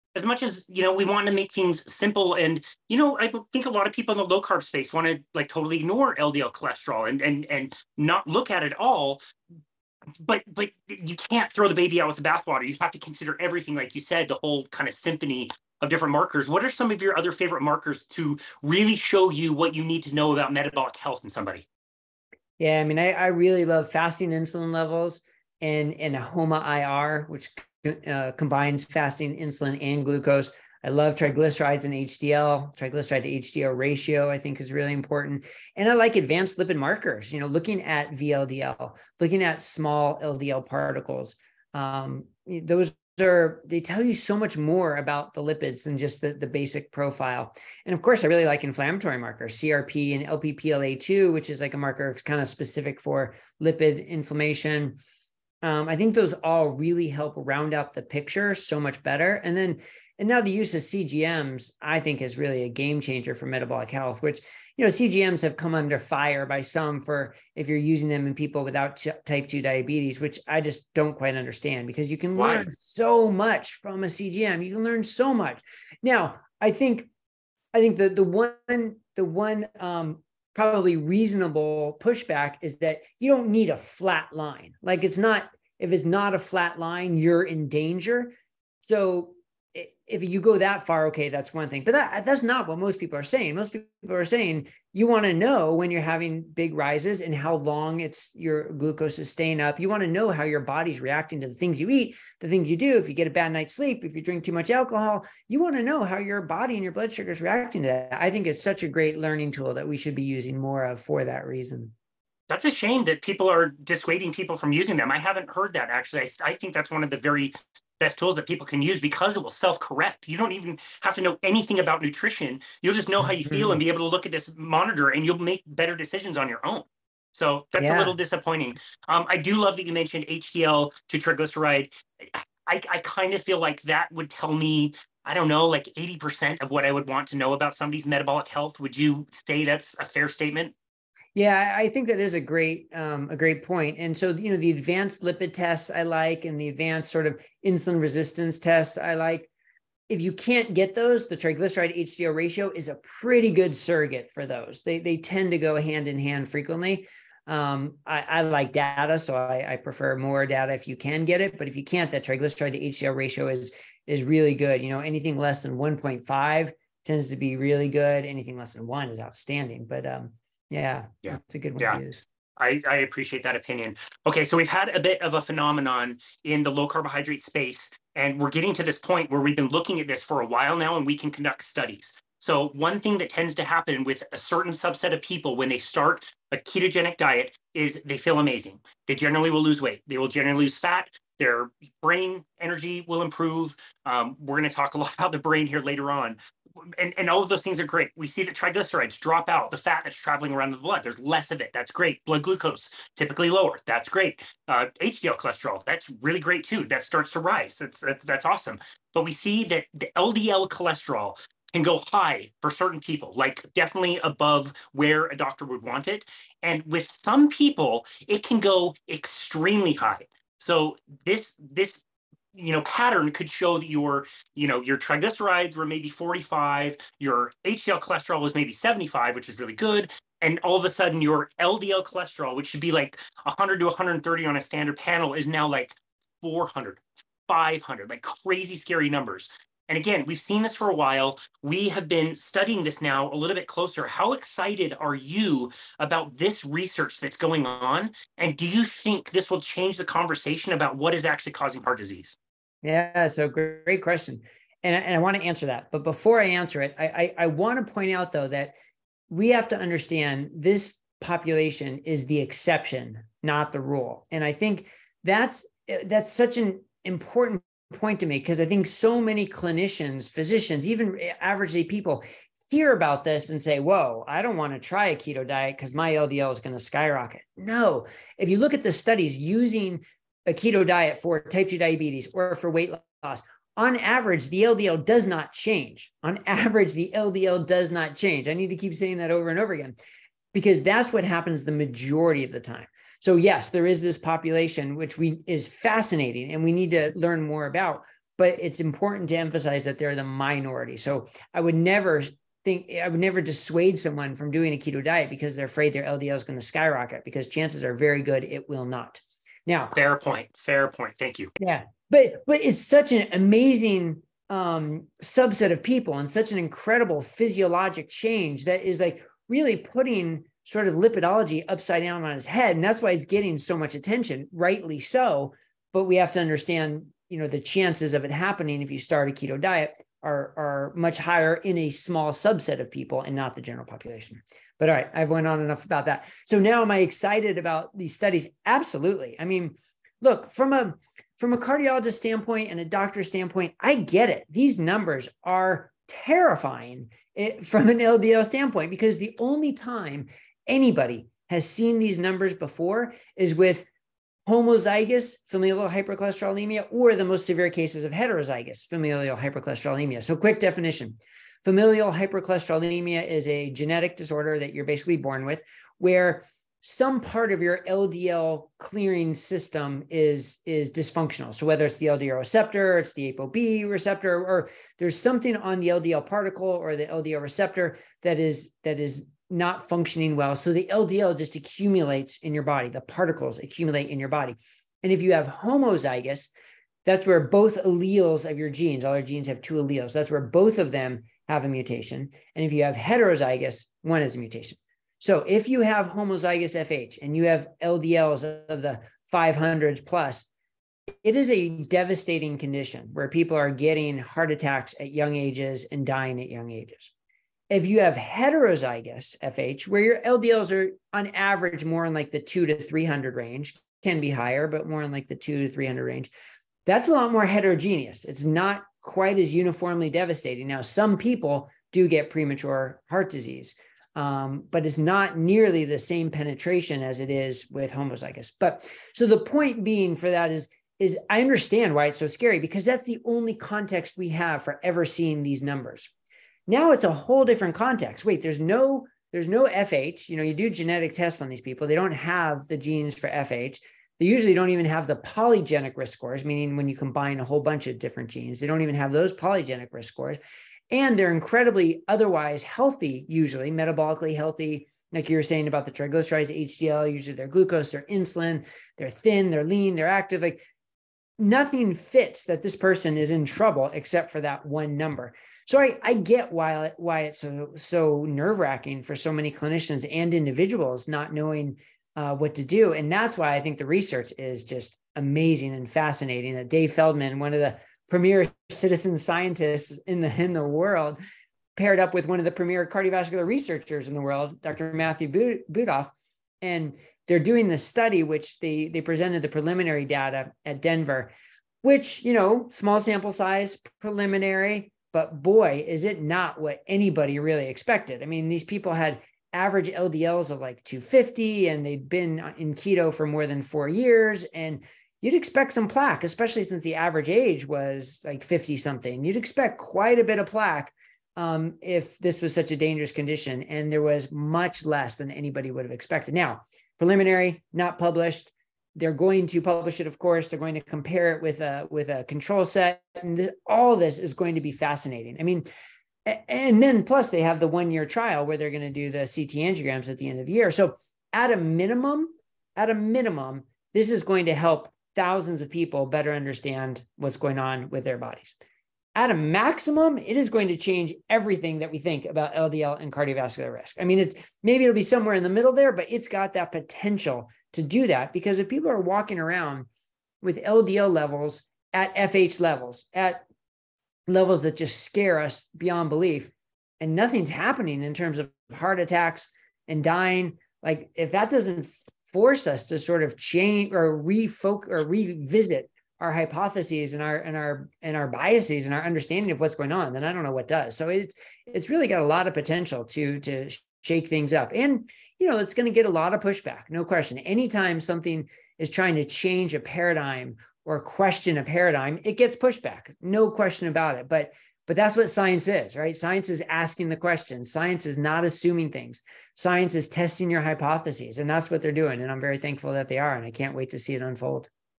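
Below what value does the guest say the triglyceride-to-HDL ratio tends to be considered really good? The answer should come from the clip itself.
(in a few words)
1.5.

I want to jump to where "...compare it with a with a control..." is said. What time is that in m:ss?
8:40.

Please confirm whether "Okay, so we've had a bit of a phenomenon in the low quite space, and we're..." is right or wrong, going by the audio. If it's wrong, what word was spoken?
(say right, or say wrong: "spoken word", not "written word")
wrong: "carbohydrate", not "quite".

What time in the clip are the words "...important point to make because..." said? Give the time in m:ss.
4:27.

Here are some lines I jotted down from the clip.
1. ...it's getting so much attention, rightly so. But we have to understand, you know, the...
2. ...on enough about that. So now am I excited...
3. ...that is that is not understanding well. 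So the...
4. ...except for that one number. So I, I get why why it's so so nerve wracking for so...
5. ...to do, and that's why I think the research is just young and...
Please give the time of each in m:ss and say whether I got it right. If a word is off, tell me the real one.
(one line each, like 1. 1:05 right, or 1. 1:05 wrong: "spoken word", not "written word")
1. 5:23 right
2. 5:35 right
3. 6:18 wrong: "functioning", not "understanding"
4. 7:43 right
5. 7:52 wrong: "amazing", not "young".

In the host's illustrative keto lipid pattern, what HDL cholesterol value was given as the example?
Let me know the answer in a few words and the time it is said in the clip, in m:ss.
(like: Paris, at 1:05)
75, at 3:48.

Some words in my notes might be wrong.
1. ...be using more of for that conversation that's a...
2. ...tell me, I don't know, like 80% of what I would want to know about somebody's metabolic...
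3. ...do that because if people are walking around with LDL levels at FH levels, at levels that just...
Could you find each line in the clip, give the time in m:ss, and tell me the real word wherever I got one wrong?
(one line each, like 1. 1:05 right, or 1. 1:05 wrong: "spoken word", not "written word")
1. 1:50 wrong: "reason", not "conversation"
2. 2:14 right
3. 9:07 right.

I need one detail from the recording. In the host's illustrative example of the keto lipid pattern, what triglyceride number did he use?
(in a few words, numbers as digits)
45.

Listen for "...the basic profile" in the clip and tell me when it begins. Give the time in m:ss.
0:46.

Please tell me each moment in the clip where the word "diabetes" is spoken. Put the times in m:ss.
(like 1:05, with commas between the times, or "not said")
1:09, 4:41.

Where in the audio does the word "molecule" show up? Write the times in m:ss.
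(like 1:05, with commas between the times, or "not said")
not said.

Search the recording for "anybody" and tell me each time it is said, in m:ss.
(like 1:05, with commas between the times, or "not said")
5:50, 8:16, 8:35.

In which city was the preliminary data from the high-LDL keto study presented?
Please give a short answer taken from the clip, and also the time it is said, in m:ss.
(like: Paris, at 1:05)
Denver, at 8:10.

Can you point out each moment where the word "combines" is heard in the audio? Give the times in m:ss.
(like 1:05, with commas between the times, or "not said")
0:28, 7:26.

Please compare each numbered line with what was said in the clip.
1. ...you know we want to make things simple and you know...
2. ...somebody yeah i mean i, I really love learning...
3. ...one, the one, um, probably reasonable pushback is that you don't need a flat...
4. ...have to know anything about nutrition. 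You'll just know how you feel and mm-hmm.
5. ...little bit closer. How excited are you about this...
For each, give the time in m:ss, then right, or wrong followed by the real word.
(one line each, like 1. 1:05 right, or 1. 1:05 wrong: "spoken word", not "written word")
1. 0:00 right
2. 0:21 wrong: "fasting", not "learning"
3. 1:18 right
4. 2:01 right
5. 4:03 right.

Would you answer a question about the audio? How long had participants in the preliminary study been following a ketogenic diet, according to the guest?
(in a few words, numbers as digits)
More than 4 years.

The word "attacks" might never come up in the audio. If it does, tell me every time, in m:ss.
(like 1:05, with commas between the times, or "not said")
6:44, 9:18.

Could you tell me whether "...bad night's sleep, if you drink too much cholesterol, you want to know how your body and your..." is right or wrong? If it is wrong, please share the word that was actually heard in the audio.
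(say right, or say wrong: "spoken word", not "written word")
wrong: "alcohol", not "cholesterol".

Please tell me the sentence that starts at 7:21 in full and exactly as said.
They don't have the genes for FH.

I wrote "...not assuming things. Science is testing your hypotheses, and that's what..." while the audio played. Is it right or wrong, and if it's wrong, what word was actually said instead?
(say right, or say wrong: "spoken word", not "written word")
right.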